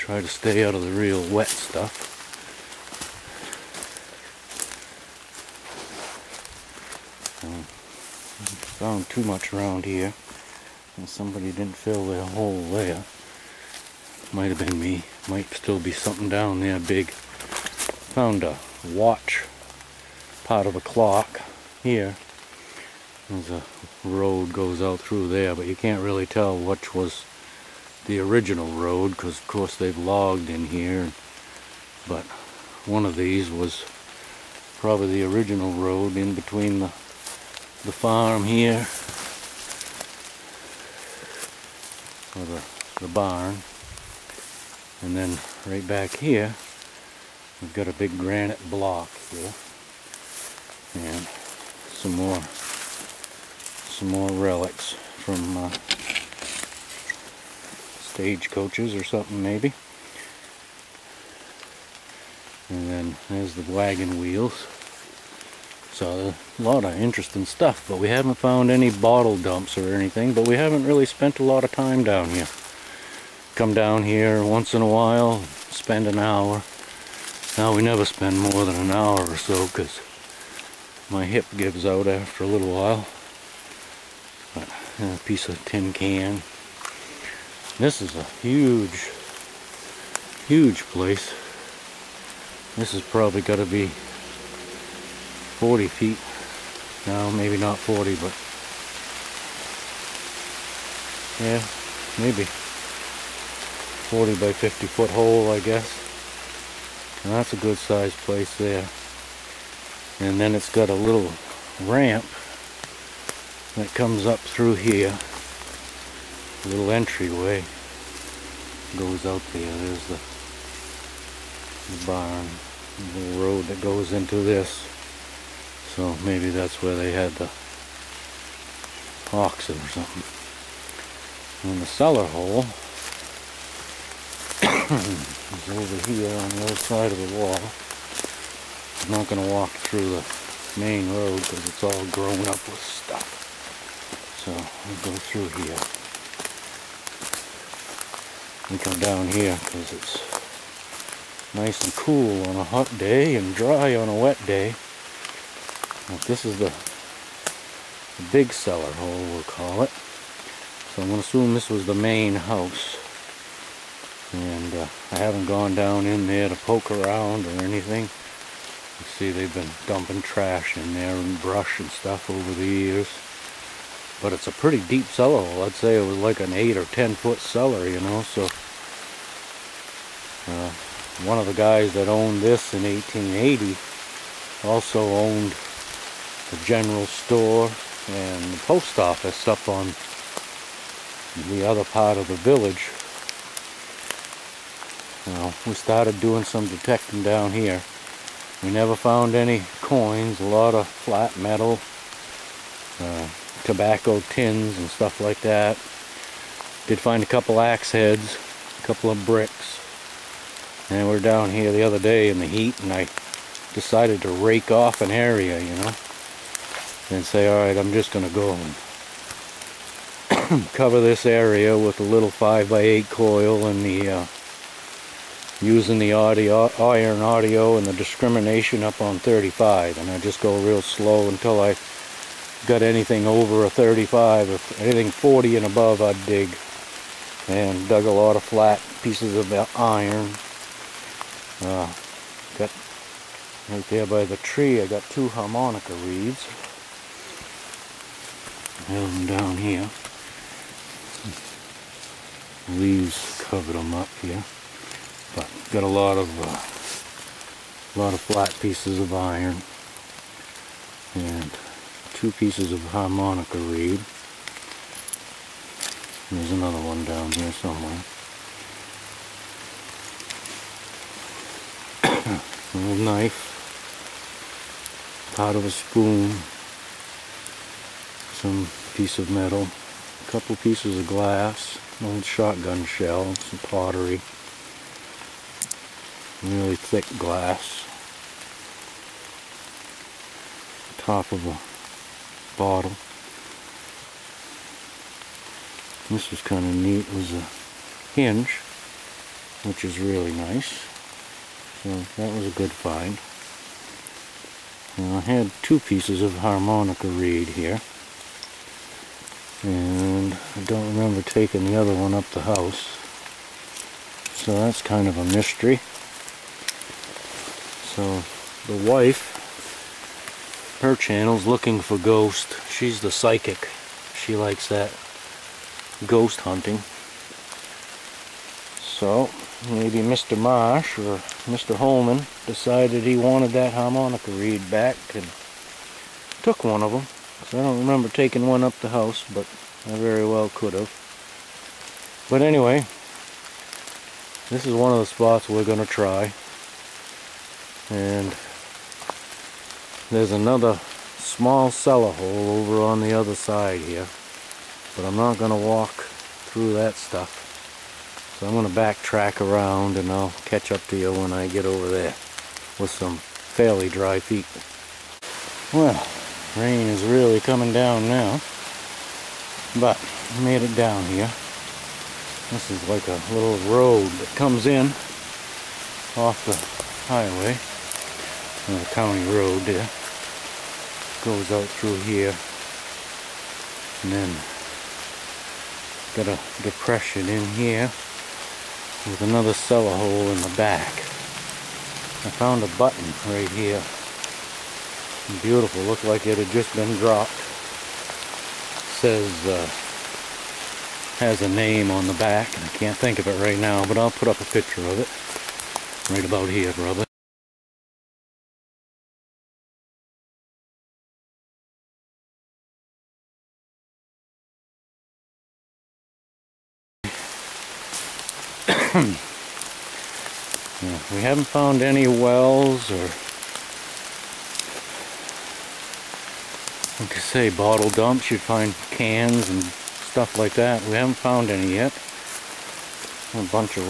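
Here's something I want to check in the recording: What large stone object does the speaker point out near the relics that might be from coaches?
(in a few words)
granite block.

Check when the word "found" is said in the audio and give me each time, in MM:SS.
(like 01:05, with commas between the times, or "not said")
00:08, 00:18, 01:08, 03:18, 06:32, 07:01, 07:11.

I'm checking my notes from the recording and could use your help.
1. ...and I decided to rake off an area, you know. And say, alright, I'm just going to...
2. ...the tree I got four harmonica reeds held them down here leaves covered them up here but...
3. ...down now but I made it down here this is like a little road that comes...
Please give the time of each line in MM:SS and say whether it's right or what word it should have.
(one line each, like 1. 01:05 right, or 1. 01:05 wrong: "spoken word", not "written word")
1. 03:32 right
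2. 04:04 wrong: "two", not "four"
3. 06:07 right.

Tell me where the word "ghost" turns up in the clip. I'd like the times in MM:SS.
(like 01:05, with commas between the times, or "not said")
05:21, 05:26.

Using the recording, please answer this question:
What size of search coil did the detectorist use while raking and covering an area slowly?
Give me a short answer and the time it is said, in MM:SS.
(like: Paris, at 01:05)
5 by 8, at 03:42.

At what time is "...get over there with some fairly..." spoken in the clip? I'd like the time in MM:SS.
06:01.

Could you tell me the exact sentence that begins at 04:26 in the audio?
There's another one down here somewhere.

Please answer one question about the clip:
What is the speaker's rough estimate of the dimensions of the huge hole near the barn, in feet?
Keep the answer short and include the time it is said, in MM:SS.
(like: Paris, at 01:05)
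40 by 50, at 01:42.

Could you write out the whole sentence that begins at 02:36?
this is the, the big cellar hole, we'll call it.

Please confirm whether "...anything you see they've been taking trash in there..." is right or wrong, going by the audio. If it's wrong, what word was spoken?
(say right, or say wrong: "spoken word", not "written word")
wrong: "dumping", not "taking".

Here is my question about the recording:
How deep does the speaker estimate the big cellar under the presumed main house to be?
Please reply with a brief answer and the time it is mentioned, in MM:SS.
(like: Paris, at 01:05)
8 or 10 feet, at 02:56.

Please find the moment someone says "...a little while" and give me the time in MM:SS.
01:22.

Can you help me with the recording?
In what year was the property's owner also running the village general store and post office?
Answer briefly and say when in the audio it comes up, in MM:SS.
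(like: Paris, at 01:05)
1880, at 03:02.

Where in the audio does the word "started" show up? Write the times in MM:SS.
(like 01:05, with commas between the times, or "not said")
03:15.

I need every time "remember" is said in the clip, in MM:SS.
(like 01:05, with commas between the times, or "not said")
05:10, 05:37.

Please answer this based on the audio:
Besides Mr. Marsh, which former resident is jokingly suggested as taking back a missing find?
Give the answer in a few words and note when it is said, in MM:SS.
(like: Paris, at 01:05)
Mr. Holman, at 05:31.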